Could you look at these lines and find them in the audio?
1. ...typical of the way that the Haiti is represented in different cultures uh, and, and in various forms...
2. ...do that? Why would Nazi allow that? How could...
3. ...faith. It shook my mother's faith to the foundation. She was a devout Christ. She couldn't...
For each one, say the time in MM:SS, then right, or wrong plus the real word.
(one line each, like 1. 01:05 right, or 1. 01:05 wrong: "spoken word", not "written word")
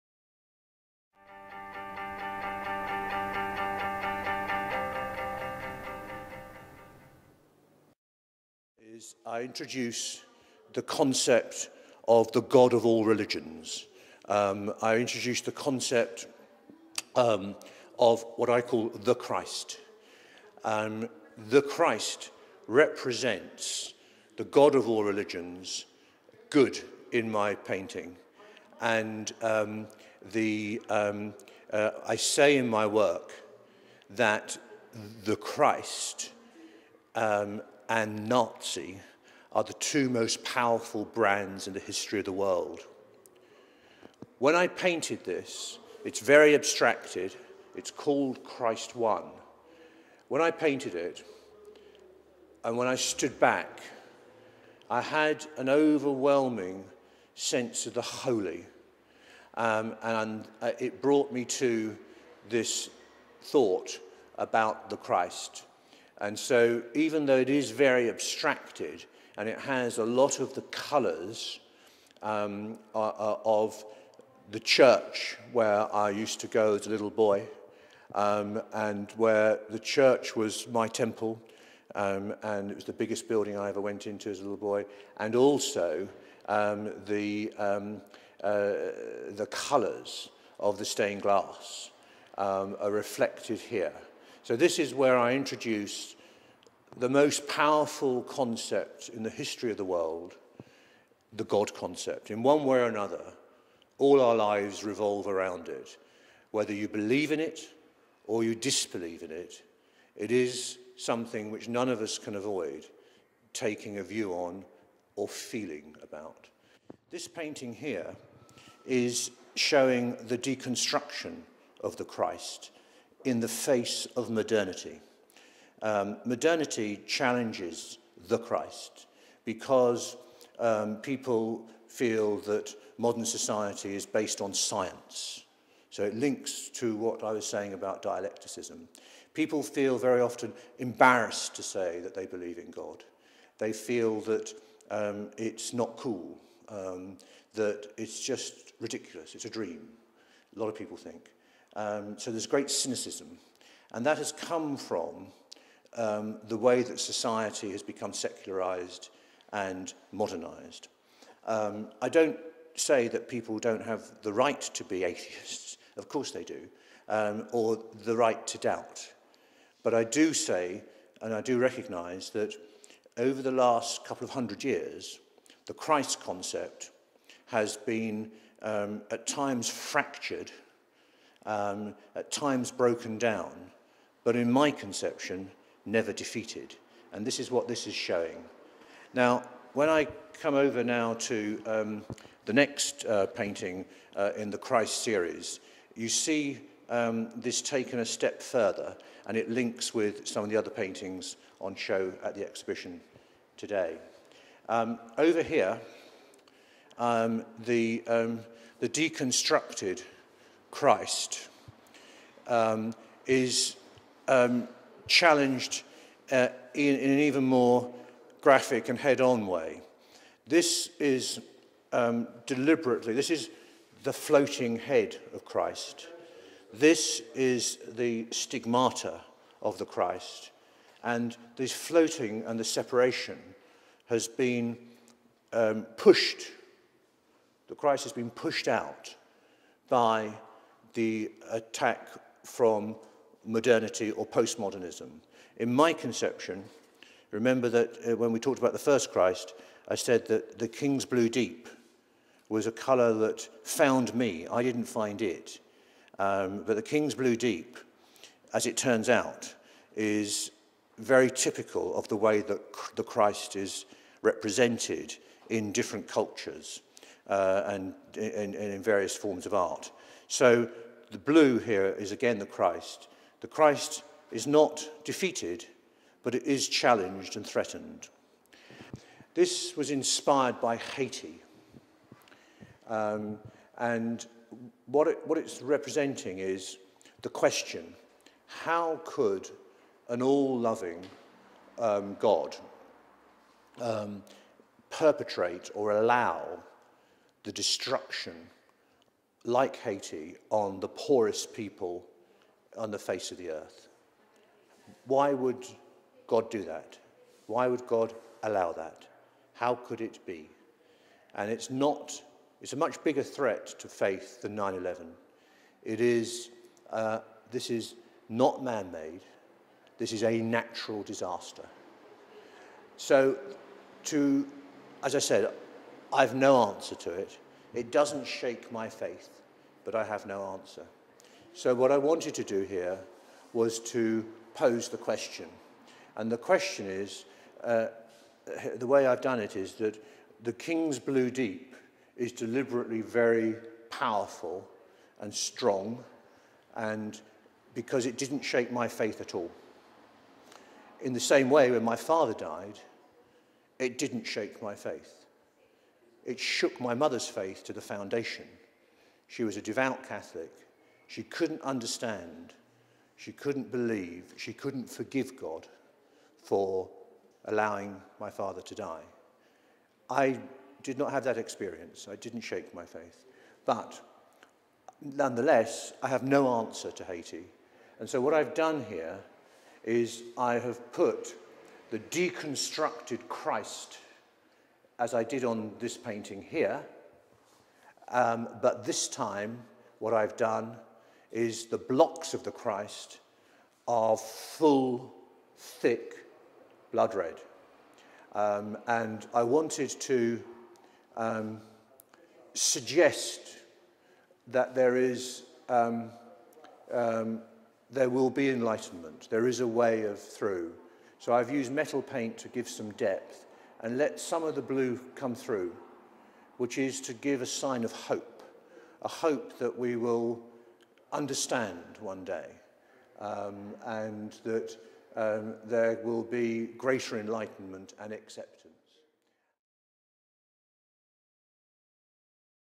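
1. 04:21 wrong: "Christ", not "Haiti"
2. 05:06 wrong: "God", not "Nazi"
3. 05:54 wrong: "Catholic", not "Christ".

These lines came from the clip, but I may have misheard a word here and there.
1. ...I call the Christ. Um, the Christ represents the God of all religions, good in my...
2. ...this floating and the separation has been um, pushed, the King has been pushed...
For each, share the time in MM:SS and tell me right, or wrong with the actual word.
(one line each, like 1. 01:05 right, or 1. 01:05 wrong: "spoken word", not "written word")
1. 00:18 right
2. 03:51 wrong: "Christ", not "King".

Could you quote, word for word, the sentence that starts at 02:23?
They feel that um, it's not cool, um, that it's just ridiculous, it's a dream, a lot of people think.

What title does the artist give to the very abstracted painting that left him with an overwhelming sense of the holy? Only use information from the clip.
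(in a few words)
Christ One.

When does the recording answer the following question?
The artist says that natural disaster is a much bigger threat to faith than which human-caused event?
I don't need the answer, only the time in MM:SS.
05:14.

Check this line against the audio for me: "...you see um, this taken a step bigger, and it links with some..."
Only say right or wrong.
wrong.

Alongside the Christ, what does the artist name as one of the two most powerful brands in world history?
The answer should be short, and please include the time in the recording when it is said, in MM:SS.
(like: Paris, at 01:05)
Nazi, at 00:38.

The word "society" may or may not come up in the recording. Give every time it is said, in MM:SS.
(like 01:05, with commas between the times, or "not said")
02:13, 02:36.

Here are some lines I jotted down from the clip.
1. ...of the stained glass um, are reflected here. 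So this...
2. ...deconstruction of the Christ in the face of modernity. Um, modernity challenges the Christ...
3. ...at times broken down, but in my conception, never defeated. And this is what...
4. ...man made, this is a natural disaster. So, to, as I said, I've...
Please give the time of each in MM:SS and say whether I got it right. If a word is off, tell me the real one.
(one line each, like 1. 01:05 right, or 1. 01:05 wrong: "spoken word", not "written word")
1. 01:30 right
2. 02:00 right
3. 03:02 right
4. 05:18 right.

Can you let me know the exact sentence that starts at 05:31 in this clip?
So what I wanted to do here was to pose the question.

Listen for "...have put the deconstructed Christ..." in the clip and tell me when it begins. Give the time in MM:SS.
06:20.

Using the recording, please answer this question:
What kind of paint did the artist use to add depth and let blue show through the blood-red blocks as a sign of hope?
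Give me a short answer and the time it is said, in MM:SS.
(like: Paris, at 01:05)
metal paint, at 06:51.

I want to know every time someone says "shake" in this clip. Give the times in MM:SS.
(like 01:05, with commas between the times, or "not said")
05:28, 05:48, 05:54, 06:12.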